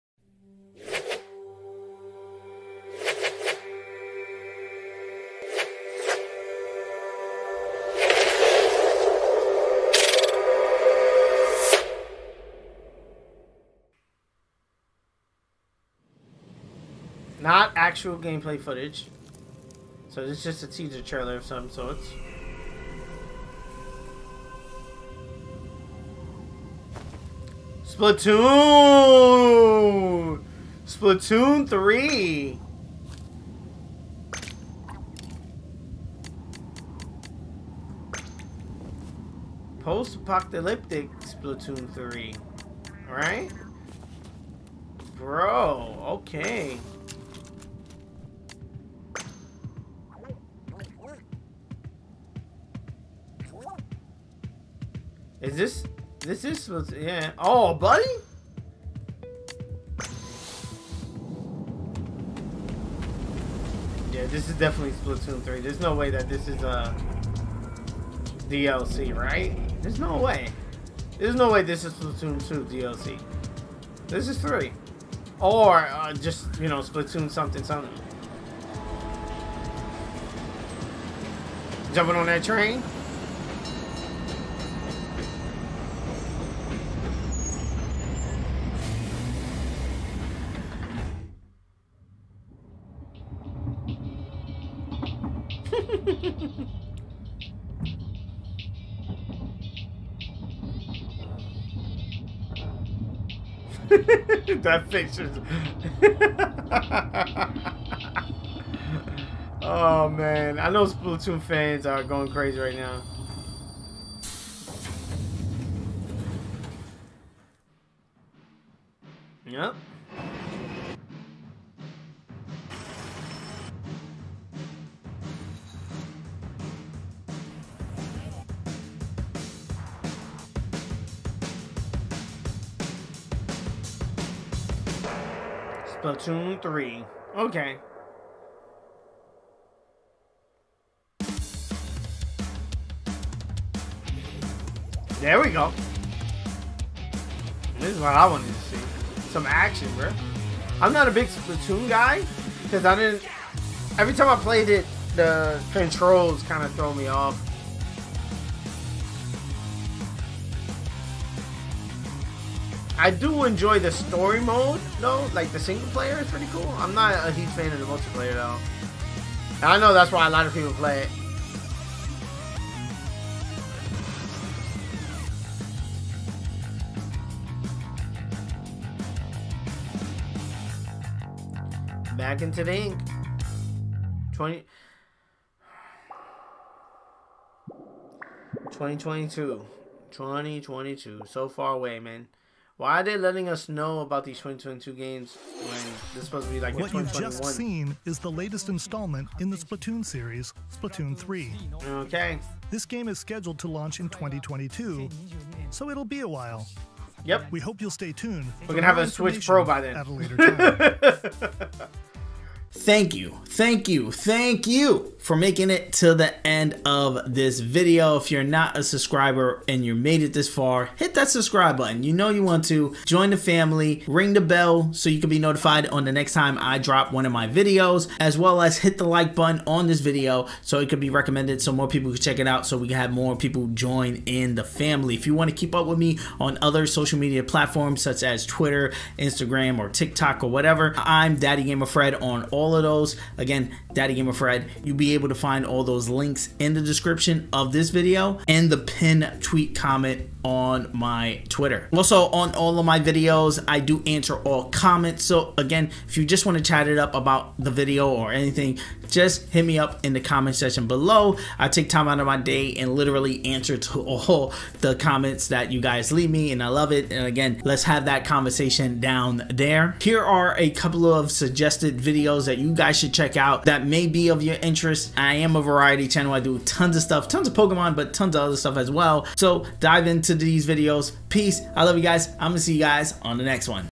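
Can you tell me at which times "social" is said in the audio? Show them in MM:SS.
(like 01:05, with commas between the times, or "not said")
03:56.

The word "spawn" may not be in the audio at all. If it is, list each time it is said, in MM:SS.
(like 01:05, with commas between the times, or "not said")
not said.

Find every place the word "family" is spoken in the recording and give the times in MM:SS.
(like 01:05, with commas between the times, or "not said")
03:43, 03:54.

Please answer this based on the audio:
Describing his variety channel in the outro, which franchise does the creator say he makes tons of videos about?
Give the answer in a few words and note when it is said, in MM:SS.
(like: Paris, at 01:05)
Pokemon, at 04:37.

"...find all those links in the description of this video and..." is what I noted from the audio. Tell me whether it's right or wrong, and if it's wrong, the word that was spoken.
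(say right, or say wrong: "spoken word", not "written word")
right.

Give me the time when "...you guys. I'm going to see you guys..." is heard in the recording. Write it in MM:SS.
04:41.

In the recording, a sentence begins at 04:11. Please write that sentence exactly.
Also on all of my videos, I do answer all comments.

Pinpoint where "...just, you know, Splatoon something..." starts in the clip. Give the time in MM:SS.
01:16.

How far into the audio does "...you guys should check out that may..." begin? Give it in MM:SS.
04:32.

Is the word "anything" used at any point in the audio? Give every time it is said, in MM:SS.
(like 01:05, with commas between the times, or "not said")
04:18.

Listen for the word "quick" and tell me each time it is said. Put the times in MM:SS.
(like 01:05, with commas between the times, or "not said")
not said.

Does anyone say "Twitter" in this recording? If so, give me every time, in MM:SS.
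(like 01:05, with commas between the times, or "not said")
03:58, 04:11.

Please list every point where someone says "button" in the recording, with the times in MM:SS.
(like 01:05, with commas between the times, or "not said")
03:41, 03:49.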